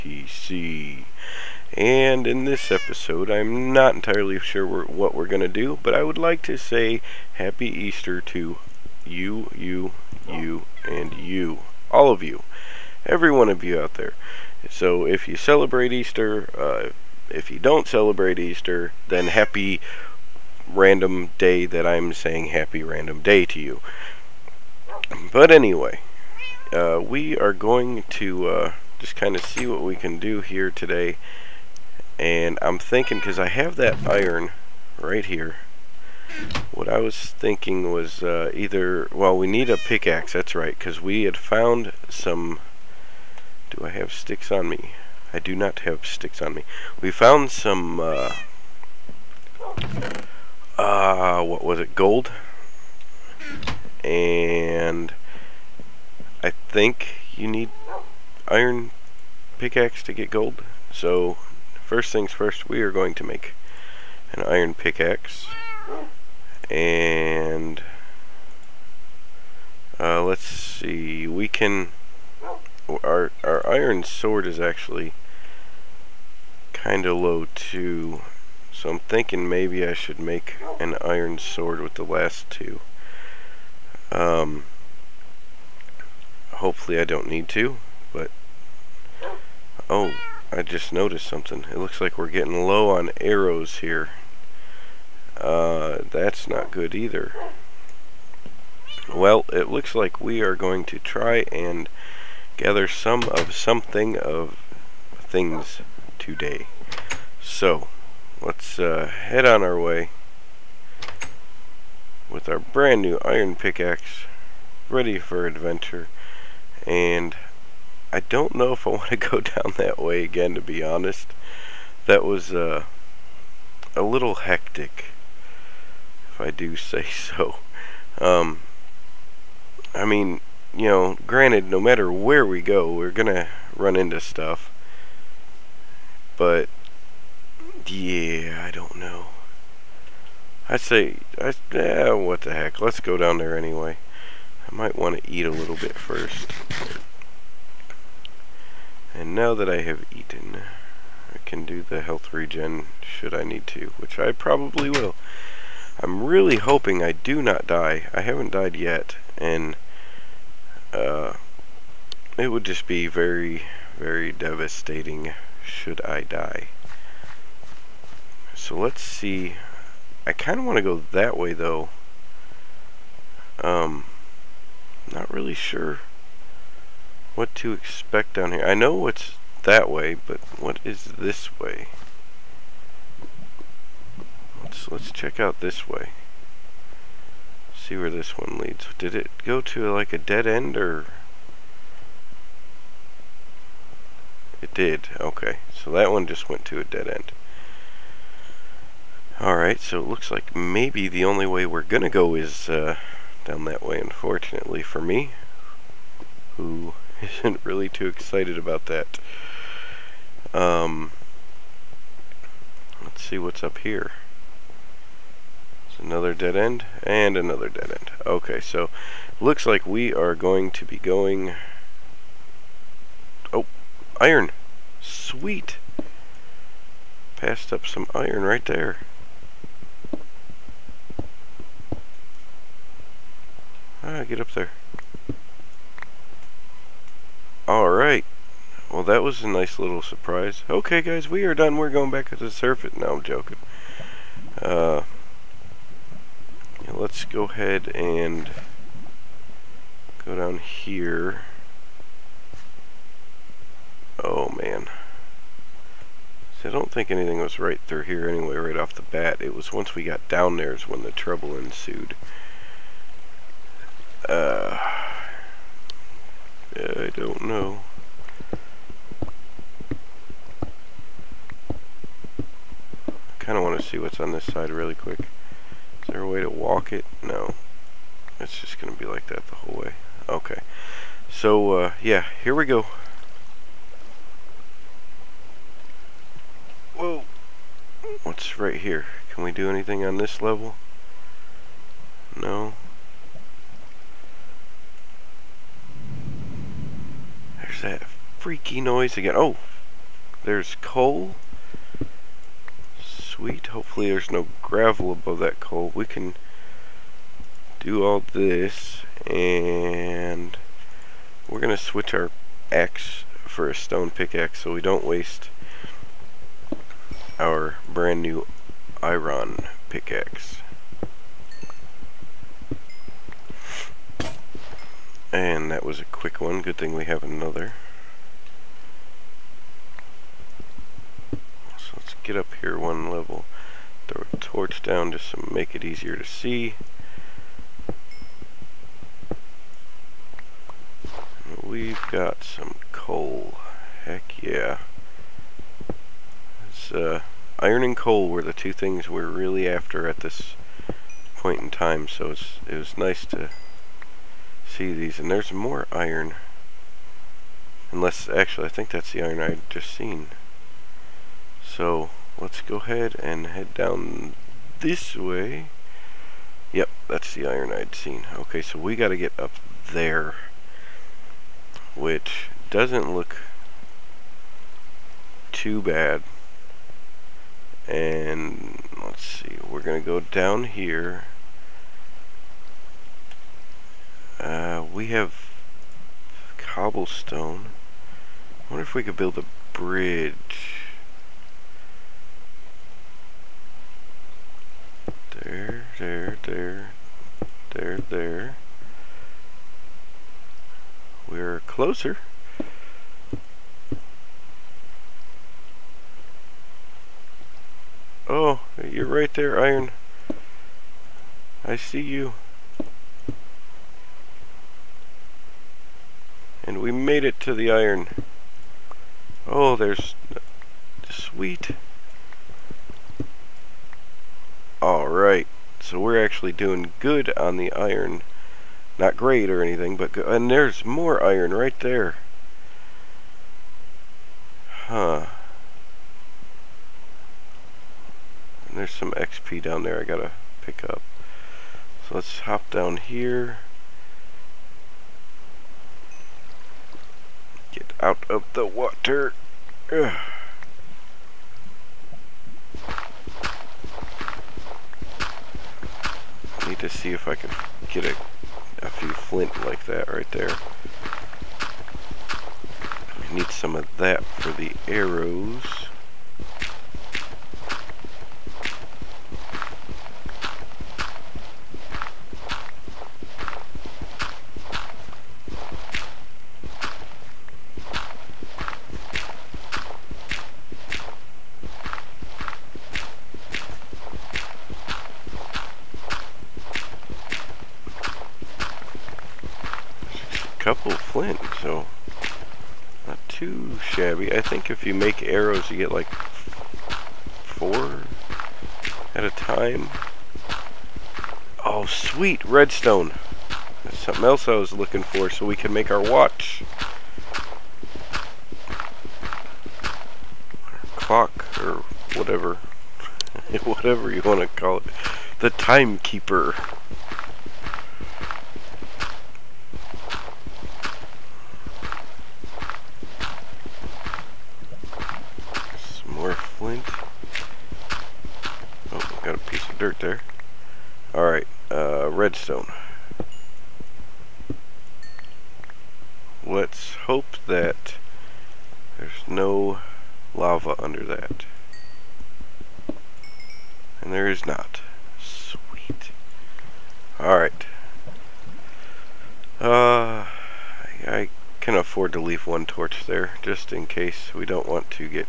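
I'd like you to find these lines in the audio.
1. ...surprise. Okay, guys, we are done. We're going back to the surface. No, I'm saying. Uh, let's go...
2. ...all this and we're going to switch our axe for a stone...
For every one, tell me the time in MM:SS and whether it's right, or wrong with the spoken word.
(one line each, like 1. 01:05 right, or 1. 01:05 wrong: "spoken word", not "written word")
1. 04:00 wrong: "joking", not "saying"
2. 05:08 right.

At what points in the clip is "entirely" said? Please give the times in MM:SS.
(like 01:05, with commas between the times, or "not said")
00:03.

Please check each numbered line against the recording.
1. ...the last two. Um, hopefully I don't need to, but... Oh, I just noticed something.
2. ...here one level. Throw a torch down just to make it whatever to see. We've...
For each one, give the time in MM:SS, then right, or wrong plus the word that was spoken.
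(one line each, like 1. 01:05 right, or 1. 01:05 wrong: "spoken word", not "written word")
1. 01:21 right
2. 05:32 wrong: "easier", not "whatever".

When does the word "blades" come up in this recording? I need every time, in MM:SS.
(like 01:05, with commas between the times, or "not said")
not said.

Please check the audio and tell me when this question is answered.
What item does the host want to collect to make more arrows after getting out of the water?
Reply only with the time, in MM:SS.
07:39.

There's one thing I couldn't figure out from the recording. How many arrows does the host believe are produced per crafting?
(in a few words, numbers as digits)
4.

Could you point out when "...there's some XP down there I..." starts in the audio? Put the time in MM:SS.
07:18.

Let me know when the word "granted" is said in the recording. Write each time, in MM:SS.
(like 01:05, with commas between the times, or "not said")
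02:11.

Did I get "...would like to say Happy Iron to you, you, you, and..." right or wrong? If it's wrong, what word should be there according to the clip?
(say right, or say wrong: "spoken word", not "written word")
wrong: "Easter", not "Iron".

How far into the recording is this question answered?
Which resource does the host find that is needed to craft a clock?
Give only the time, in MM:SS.
08:22.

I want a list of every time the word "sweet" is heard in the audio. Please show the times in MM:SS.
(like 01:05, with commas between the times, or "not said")
03:45, 05:03, 07:01, 08:21.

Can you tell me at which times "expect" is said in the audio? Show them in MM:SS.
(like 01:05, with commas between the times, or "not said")
02:57.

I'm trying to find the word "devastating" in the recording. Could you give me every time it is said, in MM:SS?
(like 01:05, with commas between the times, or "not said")
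02:44.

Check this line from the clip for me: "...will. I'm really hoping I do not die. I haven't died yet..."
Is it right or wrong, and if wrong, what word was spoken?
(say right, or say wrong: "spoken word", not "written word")
right.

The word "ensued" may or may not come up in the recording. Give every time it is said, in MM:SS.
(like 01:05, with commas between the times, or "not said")
04:21.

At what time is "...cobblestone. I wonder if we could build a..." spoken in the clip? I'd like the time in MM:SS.
06:26.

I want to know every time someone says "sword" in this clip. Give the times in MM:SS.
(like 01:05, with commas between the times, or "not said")
01:14, 01:21.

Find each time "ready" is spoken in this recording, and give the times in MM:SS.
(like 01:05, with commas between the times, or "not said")
01:54.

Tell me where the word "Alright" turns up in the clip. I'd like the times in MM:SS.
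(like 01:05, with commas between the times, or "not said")
03:19, 03:57, 07:04.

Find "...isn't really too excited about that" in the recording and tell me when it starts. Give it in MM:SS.
03:27.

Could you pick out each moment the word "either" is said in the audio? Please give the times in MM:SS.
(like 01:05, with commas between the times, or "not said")
00:38, 01:36.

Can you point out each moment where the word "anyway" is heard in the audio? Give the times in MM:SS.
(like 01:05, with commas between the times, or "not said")
00:25, 02:23, 04:18.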